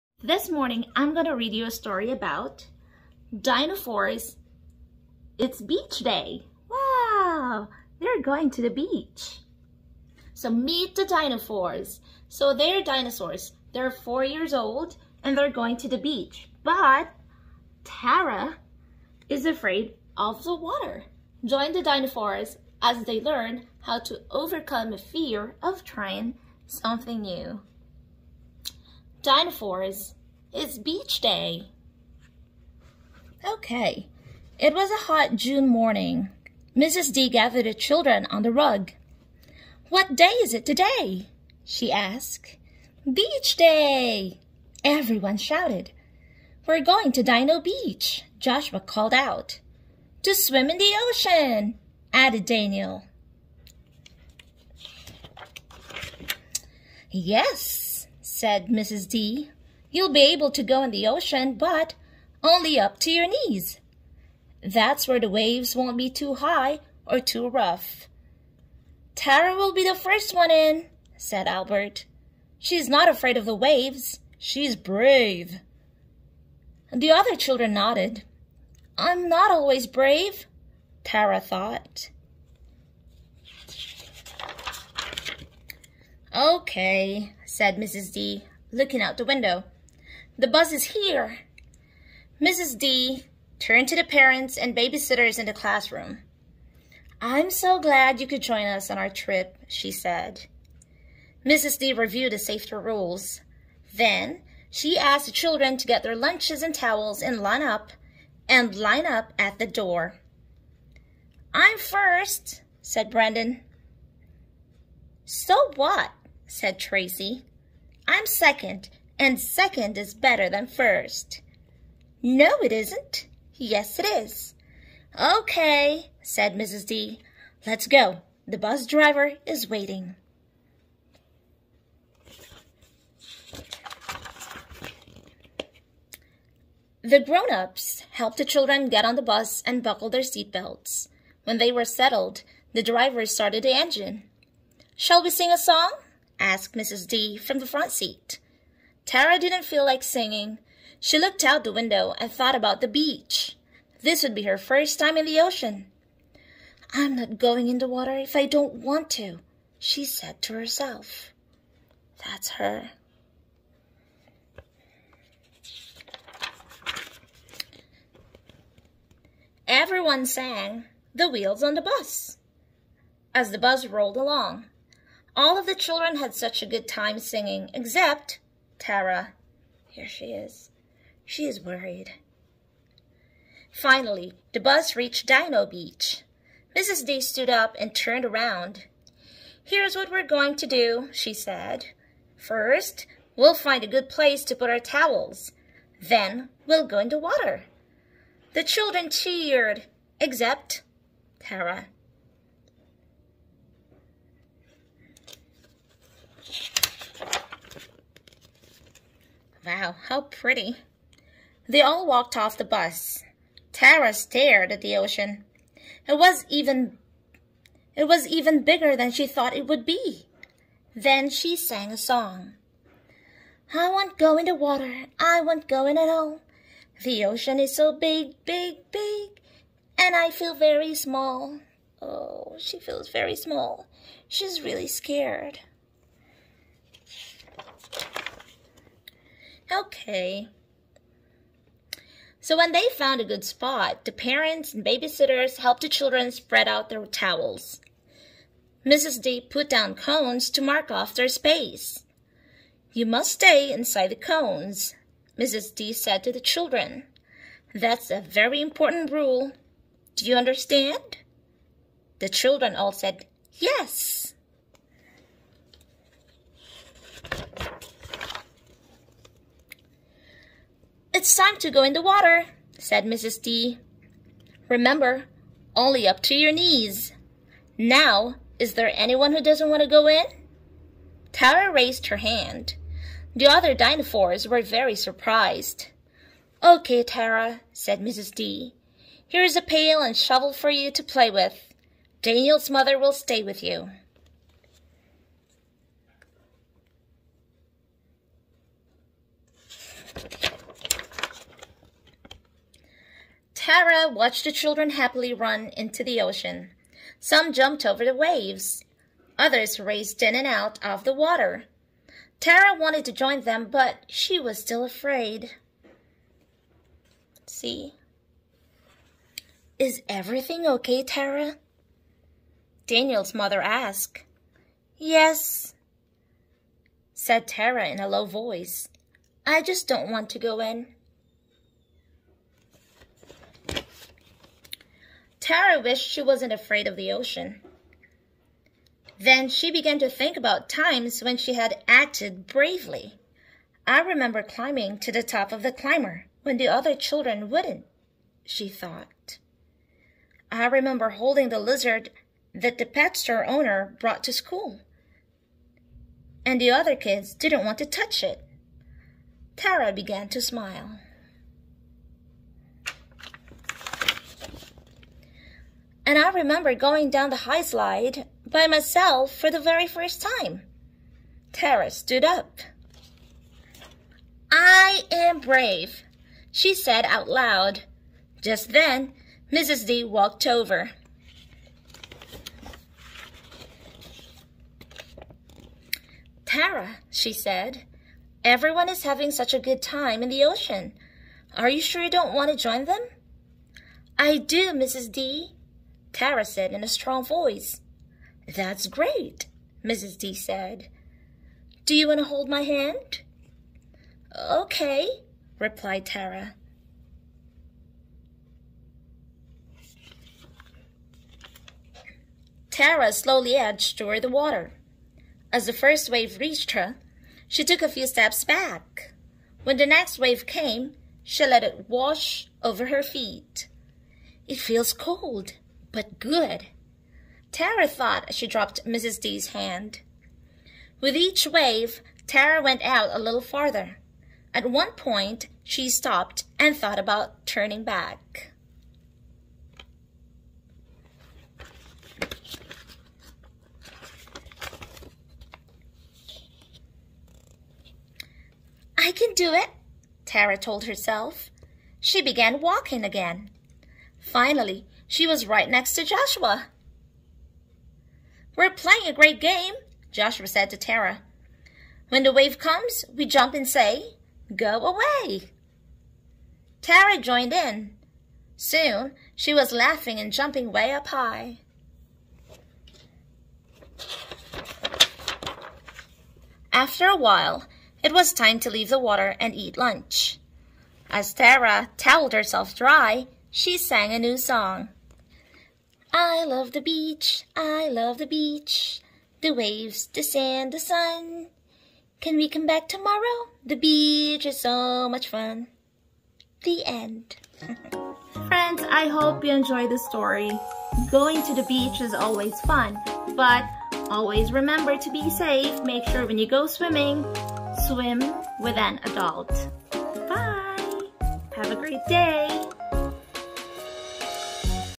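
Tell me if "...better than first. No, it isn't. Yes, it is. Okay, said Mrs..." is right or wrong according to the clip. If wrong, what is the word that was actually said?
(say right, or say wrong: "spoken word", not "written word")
right.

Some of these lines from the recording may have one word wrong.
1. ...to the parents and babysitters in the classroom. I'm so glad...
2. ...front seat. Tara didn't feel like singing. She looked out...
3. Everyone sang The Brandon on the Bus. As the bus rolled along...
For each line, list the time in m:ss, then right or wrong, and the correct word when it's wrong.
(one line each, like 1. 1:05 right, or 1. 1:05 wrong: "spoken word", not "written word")
1. 1:33 right
2. 2:27 right
3. 2:49 wrong: "Wheels", not "Brandon".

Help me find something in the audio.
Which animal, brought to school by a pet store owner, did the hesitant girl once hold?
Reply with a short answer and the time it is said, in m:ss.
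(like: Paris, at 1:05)
lizard, at 5:51.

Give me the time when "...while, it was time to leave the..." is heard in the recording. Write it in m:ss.
7:57.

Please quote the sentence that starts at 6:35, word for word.
D, Tara said in a strong voice.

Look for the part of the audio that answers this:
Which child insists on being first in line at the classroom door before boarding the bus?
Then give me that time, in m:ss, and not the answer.
1:53.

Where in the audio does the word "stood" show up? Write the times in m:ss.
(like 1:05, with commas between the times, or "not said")
3:07, 6:11.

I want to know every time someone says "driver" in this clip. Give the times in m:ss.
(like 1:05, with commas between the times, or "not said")
2:08, 2:22.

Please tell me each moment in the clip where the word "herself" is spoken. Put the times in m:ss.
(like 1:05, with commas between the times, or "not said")
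2:40, 7:30, 8:02.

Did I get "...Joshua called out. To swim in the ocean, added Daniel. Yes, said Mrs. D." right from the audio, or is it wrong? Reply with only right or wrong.
right.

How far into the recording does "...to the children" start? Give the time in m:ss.
4:16.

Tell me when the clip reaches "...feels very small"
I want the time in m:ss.
3:52.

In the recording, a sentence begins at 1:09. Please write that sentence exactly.
Tara will be the first one in, said Albert.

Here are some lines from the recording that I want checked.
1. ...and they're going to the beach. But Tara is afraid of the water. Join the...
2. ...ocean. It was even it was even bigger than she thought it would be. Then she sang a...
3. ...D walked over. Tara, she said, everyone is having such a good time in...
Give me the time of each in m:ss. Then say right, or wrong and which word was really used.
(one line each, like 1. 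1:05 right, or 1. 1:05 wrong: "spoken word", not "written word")
1. 0:15 right
2. 3:34 right
3. 6:19 right.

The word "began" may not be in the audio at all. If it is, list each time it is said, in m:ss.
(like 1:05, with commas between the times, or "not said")
5:39, 5:59, 7:32.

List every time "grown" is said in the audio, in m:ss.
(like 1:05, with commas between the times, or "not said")
2:17.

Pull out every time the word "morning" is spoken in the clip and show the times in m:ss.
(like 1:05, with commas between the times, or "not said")
0:00, 0:35.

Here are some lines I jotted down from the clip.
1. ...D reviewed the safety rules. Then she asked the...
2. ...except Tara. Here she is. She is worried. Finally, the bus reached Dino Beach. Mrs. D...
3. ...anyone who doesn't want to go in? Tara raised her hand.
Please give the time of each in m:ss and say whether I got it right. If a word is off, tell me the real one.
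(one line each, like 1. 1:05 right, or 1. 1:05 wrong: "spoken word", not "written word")
1. 1:41 right
2. 2:57 right
3. 4:38 right.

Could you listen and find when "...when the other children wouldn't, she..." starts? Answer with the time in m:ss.
5:46.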